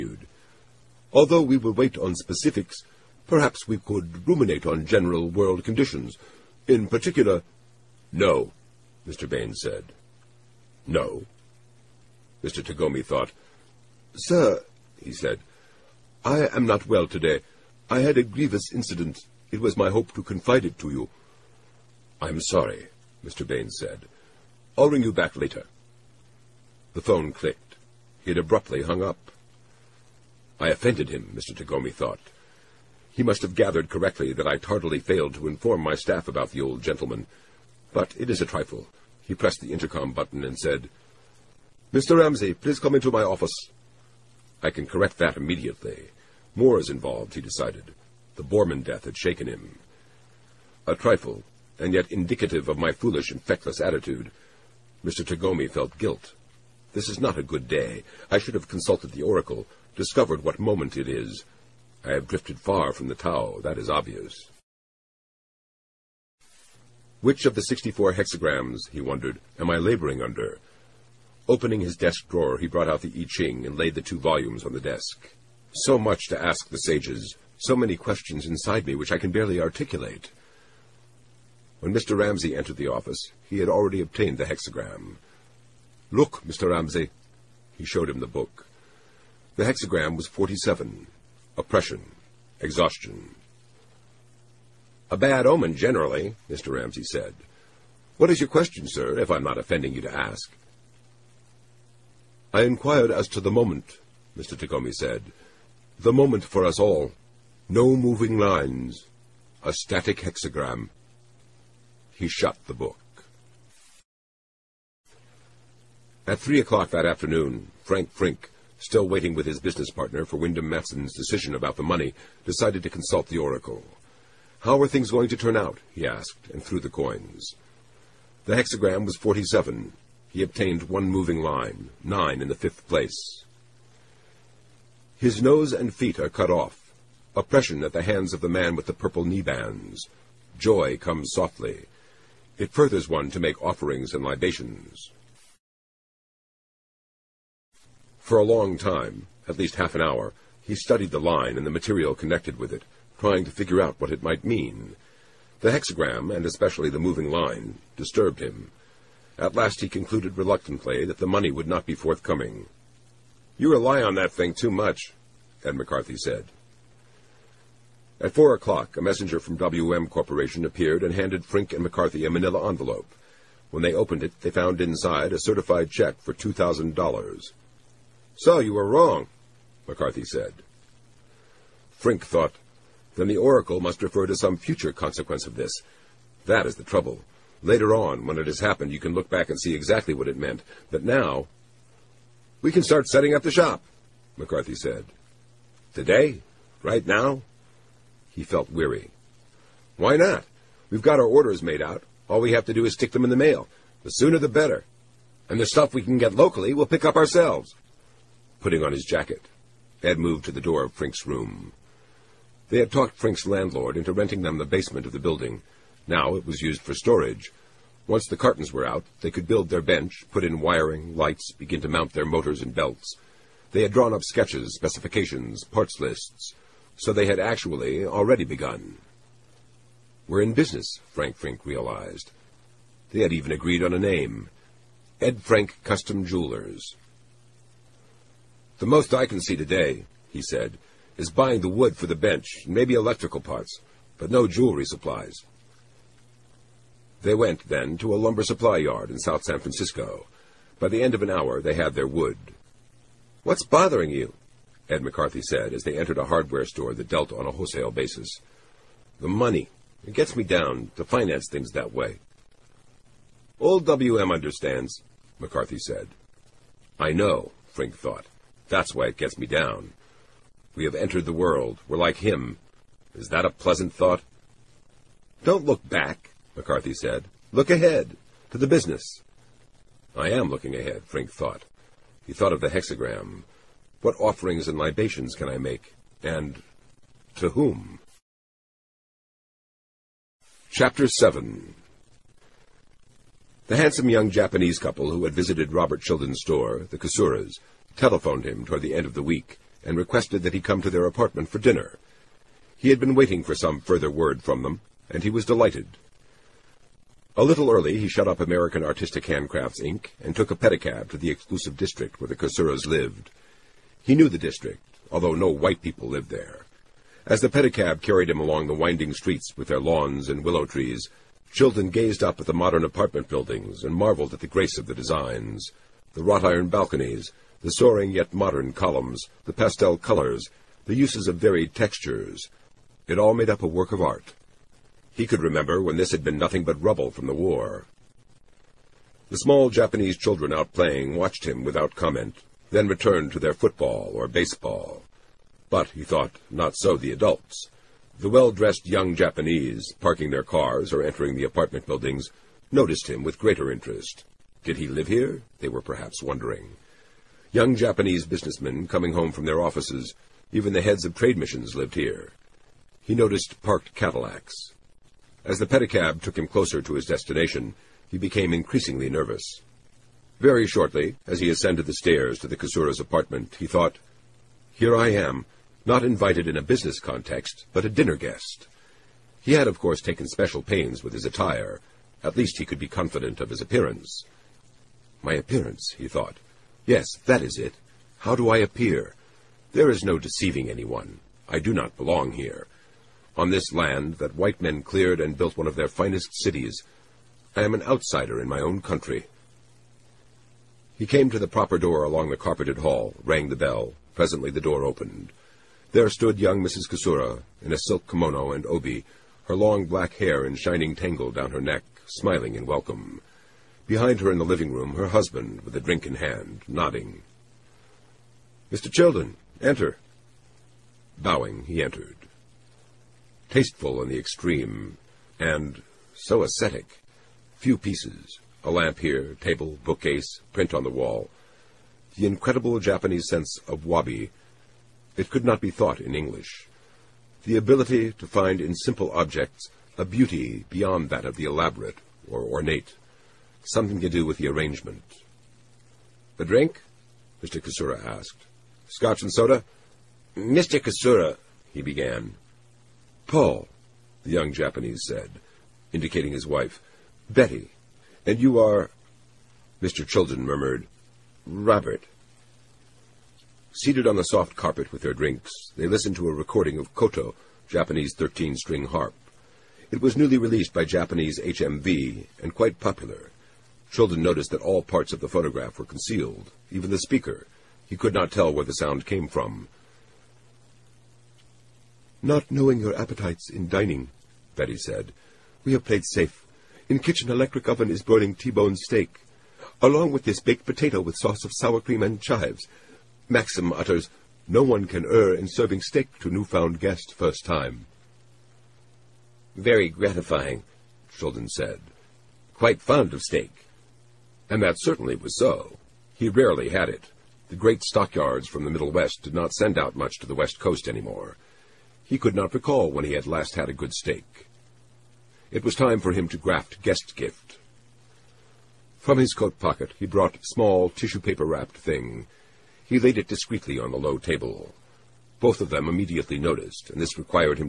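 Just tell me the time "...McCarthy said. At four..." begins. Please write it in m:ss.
2:45.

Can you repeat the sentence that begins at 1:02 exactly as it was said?
I have drifted far from the Tao, that is obvious.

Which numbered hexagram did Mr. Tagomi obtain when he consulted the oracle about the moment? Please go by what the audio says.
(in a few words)
47.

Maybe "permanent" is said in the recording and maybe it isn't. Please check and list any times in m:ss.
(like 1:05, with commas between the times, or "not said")
not said.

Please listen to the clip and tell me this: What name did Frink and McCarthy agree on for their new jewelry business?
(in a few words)
Ed Frank Custom Jewelers.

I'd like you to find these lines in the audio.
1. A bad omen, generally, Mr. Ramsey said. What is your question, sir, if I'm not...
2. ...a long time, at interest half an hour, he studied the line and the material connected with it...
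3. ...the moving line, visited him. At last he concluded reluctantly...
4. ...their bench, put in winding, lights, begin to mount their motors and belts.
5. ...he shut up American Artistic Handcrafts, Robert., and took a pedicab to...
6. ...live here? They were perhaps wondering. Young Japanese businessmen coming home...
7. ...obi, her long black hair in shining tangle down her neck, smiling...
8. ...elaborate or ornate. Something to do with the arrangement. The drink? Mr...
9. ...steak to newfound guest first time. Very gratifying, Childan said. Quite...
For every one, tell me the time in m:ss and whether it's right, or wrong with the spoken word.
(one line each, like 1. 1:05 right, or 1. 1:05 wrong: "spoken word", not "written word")
1. 1:35 right
2. 2:28 wrong: "least", not "interest"
3. 2:36 wrong: "disturbed", not "visited"
4. 3:39 wrong: "wiring", not "winding"
5. 5:07 wrong: "Inc", not "Robert"
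6. 5:54 right
7. 6:48 right
8. 7:21 right
9. 8:15 right.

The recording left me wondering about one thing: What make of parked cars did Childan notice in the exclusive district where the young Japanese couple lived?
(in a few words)
Cadillacs.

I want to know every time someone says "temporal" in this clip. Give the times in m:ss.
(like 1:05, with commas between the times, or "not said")
not said.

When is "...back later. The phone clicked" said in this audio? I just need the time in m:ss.
0:25.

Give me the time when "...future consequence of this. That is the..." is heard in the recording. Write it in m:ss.
3:04.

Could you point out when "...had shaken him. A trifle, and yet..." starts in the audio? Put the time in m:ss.
0:49.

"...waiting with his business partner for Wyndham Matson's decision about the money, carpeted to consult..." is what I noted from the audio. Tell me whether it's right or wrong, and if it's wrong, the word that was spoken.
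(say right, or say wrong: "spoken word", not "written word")
wrong: "decided", not "carpeted".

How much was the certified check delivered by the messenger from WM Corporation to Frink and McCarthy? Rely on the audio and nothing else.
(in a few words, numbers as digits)
$2,000.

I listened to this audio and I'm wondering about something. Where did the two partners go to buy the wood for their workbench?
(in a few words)
South San Francisco.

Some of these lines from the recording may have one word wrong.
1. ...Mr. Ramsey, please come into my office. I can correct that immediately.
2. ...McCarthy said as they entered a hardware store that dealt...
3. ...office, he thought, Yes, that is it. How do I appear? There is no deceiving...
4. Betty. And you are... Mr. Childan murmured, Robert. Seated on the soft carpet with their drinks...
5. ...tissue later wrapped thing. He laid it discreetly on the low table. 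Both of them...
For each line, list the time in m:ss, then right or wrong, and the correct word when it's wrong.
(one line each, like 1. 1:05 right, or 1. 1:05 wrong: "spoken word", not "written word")
1. 0:41 right
2. 4:15 right
3. 6:25 wrong: "appearance", not "office"
4. 7:37 right
5. 8:40 wrong: "paper", not "later".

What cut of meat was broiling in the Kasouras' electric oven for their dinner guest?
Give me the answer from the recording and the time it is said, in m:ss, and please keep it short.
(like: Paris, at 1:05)
T-bone steak, at 8:08.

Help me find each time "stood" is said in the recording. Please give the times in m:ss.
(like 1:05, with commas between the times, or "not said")
6:46.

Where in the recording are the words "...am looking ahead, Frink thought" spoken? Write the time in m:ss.
4:40.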